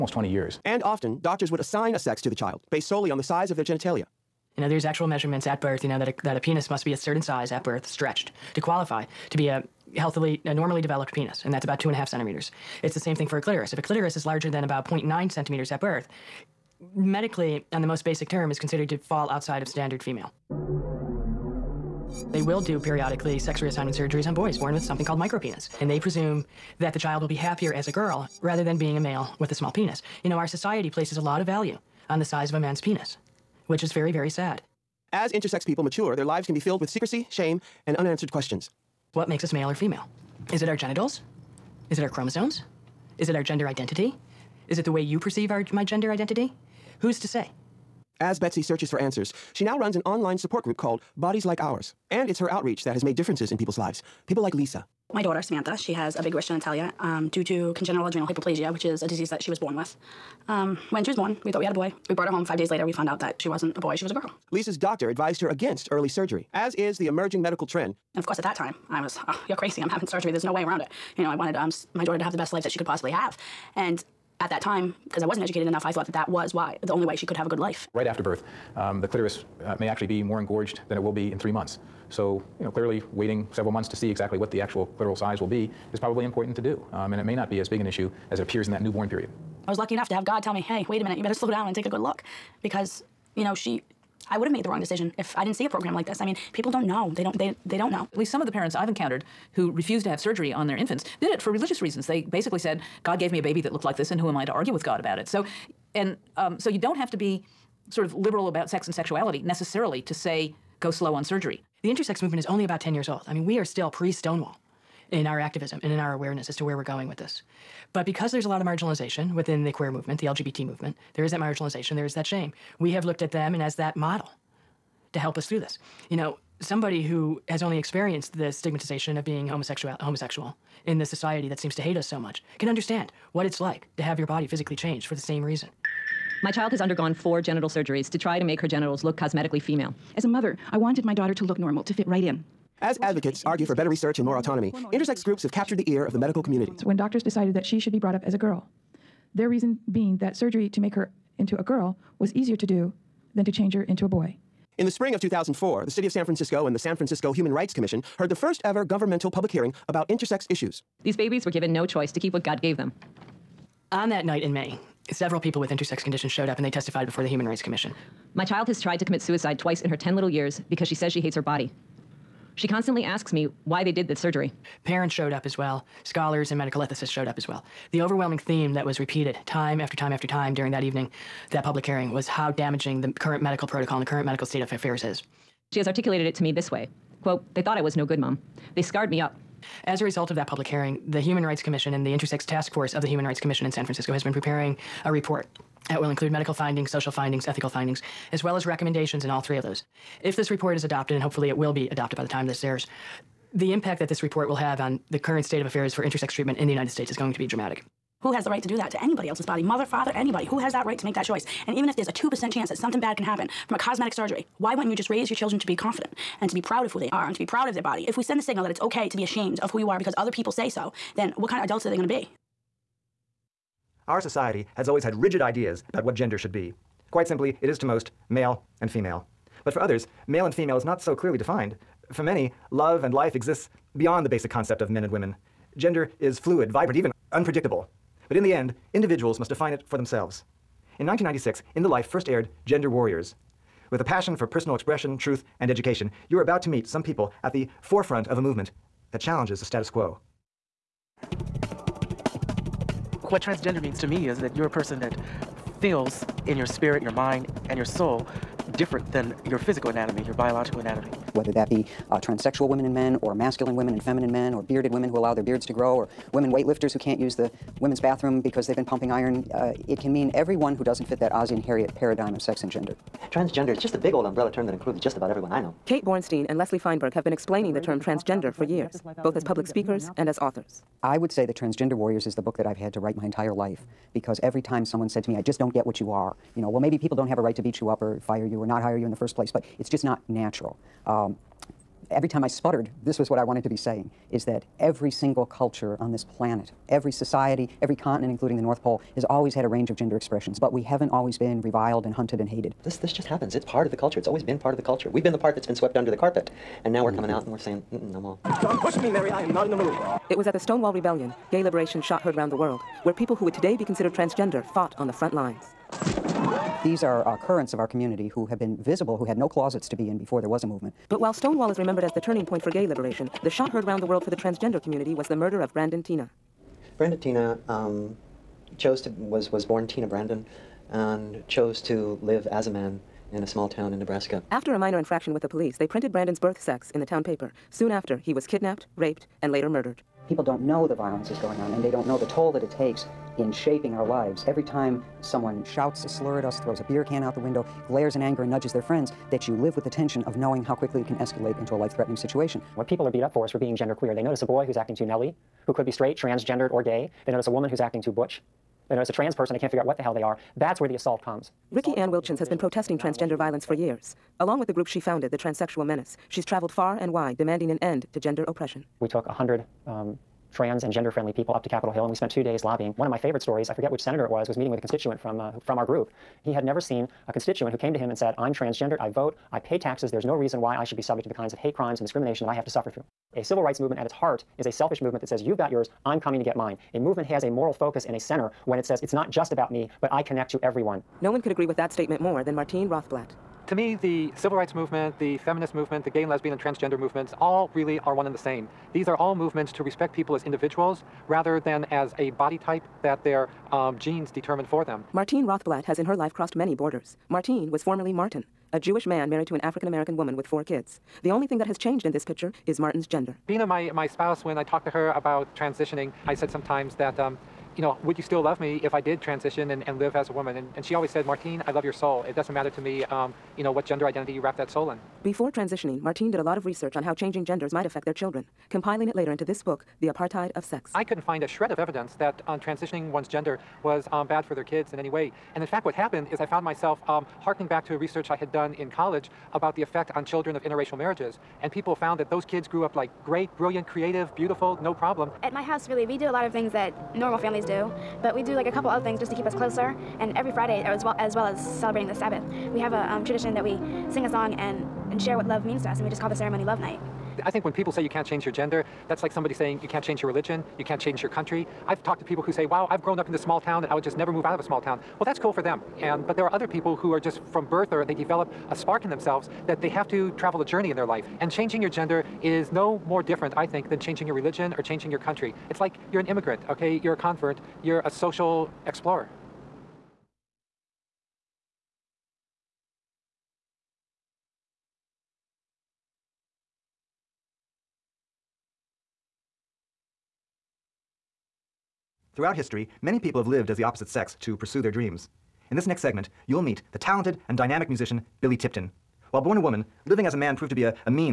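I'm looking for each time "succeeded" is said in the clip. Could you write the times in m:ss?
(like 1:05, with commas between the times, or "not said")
not said.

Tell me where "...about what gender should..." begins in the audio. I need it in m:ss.
3:45.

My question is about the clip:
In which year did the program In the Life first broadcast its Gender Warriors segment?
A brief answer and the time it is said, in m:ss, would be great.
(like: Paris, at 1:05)
1996, at 4:01.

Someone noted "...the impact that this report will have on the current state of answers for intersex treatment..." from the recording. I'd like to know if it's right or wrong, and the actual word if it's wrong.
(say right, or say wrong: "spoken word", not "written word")
wrong: "affairs", not "answers".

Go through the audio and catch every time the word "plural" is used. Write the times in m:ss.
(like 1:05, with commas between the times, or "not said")
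not said.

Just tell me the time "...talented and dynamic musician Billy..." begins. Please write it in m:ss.
8:16.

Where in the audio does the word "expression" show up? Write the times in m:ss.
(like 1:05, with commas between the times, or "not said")
4:04, 5:00.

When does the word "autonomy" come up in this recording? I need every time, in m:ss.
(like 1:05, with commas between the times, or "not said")
2:24.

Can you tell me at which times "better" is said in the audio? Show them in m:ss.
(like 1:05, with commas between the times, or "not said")
1:31, 2:23.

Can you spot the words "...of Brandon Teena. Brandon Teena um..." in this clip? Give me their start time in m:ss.
5:25.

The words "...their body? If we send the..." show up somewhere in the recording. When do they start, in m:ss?
3:37.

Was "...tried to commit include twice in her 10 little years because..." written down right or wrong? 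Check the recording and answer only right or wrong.
wrong.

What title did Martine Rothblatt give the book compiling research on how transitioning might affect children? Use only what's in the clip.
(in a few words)
The Apartheid of Sex.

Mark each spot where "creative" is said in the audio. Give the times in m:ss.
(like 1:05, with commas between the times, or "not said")
7:23.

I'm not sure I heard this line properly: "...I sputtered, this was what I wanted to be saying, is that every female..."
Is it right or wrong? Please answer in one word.
wrong.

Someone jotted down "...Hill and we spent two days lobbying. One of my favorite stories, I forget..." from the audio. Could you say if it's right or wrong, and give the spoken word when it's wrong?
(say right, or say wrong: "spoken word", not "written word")
right.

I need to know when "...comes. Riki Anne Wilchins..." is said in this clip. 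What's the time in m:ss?
6:01.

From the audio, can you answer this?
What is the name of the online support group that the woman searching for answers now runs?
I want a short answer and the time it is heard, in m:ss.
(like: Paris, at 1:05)
Bodies Like Ours, at 0:51.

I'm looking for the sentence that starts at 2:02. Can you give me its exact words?
We have looked at them and as that model to help us through this.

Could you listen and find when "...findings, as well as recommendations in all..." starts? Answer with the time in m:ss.
3:17.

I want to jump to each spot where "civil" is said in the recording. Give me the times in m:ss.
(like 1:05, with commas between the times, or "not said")
6:23, 6:34.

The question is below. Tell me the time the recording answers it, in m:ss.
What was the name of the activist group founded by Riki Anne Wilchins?
6:05.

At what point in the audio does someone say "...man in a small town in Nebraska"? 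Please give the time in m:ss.
5:32.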